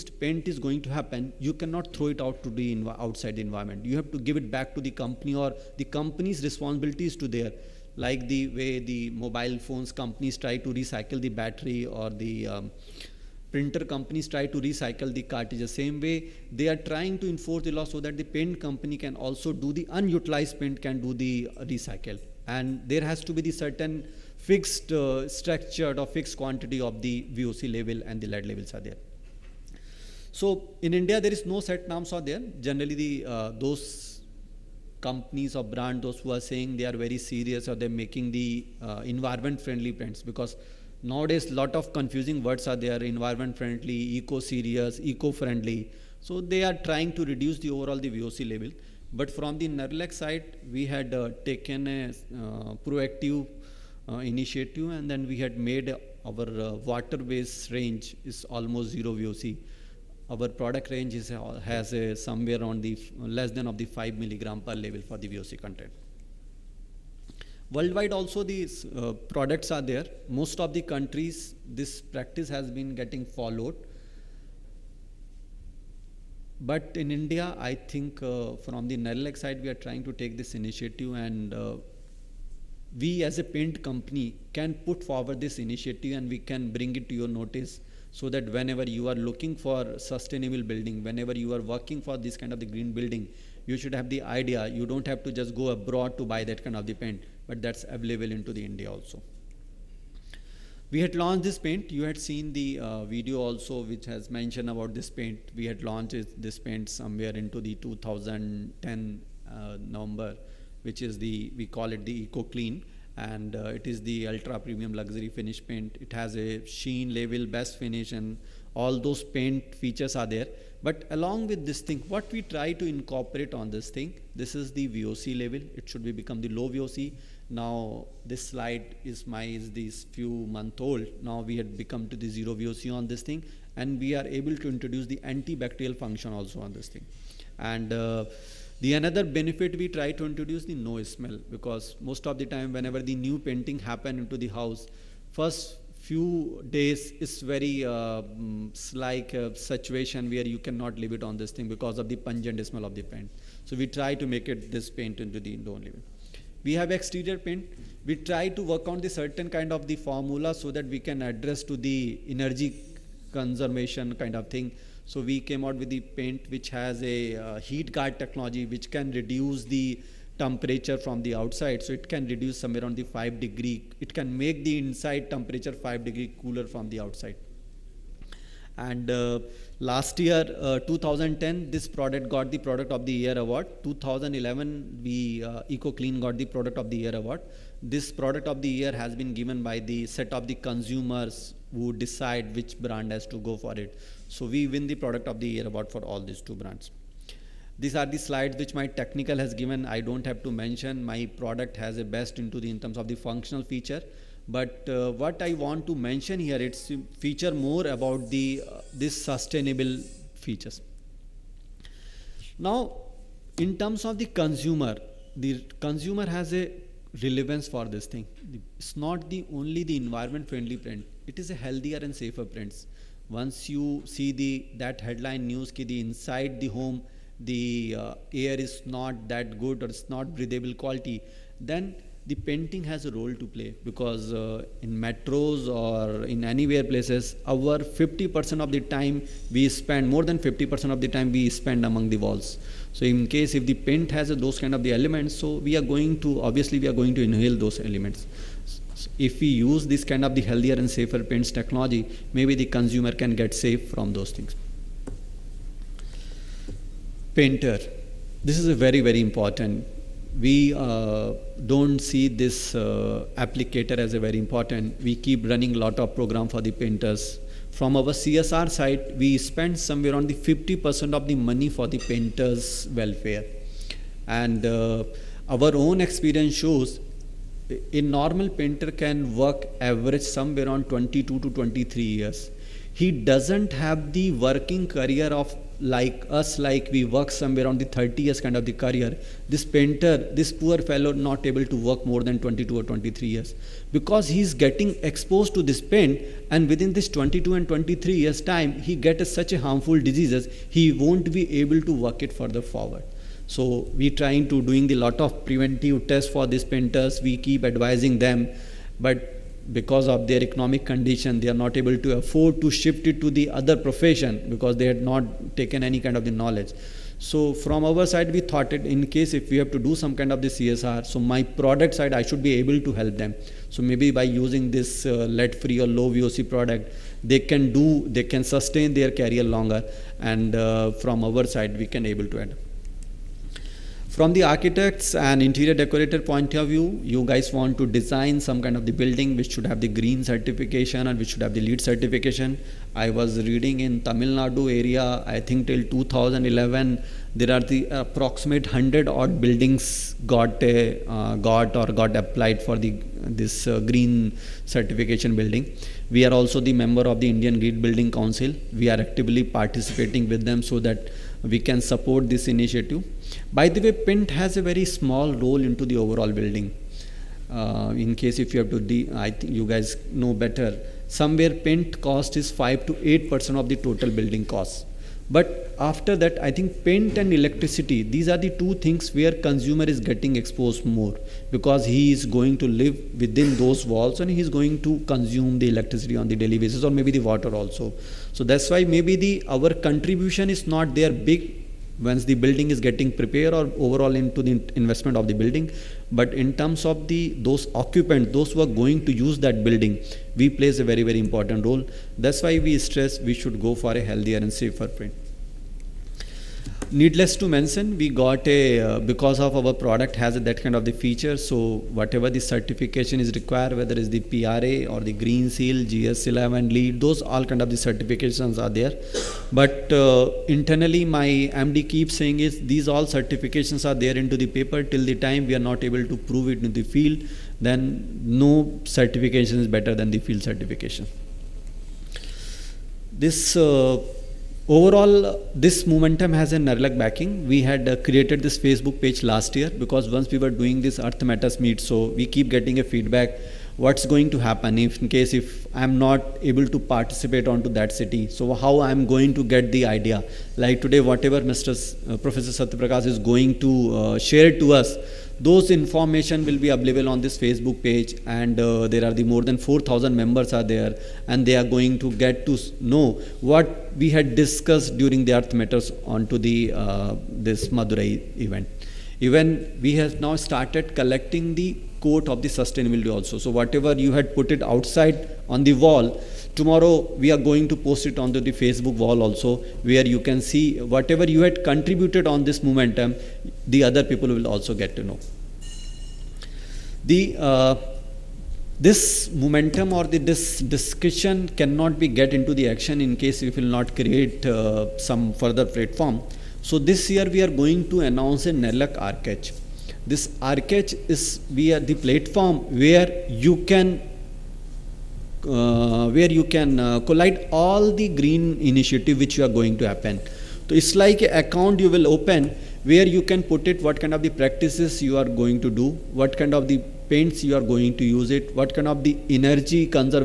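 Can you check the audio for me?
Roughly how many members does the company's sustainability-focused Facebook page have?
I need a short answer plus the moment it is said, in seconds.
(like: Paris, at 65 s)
4000, at 459 s.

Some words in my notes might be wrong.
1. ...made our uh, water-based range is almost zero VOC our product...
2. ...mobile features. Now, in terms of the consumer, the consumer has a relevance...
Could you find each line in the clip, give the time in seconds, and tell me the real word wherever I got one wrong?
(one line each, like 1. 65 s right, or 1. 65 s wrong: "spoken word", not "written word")
1. 55 s right
2. 209 s wrong: "sustainable", not "mobile".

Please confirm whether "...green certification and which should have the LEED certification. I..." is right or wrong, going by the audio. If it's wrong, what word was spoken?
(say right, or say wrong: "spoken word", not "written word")
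right.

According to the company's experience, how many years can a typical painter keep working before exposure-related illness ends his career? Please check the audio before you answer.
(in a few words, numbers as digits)
22 to 23 years.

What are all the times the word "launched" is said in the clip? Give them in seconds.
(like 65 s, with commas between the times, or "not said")
101 s, 105 s.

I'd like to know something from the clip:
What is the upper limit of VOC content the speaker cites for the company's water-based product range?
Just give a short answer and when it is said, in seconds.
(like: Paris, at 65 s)
5 milligram, at 63 s.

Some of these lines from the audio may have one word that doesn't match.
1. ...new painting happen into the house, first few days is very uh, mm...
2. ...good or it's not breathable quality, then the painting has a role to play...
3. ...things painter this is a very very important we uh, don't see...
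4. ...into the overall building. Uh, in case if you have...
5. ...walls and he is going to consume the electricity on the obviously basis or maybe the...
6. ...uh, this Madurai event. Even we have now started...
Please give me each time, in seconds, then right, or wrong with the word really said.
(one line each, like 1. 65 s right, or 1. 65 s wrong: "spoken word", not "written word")
1. 143 s right
2. 229 s right
3. 254 s right
4. 365 s right
5. 383 s wrong: "daily", not "obviously"
6. 466 s right.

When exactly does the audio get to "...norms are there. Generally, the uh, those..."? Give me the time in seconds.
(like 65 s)
31 s.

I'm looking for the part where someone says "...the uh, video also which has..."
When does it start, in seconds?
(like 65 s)
102 s.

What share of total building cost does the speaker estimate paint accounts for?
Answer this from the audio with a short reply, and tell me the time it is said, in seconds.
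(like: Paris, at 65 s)
5 to 8%, at 372 s.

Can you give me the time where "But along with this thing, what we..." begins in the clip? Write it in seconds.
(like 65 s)
120 s.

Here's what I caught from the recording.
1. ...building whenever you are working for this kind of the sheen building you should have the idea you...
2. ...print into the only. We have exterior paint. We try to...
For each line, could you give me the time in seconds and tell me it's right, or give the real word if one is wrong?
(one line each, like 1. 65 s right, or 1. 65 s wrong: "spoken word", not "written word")
1. 90 s wrong: "green", not "sheen"
2. 154 s wrong: "paint", not "print".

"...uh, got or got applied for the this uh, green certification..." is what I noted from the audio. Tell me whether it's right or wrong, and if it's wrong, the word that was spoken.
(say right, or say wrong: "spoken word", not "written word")
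right.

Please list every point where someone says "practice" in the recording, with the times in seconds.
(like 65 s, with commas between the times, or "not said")
72 s, 514 s.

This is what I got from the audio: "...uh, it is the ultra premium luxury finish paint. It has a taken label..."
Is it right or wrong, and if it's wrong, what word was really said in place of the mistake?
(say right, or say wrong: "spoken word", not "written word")
wrong: "sheen", not "taken".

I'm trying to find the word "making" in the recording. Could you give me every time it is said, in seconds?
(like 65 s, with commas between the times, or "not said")
38 s.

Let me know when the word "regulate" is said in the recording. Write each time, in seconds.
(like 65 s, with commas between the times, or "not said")
not said.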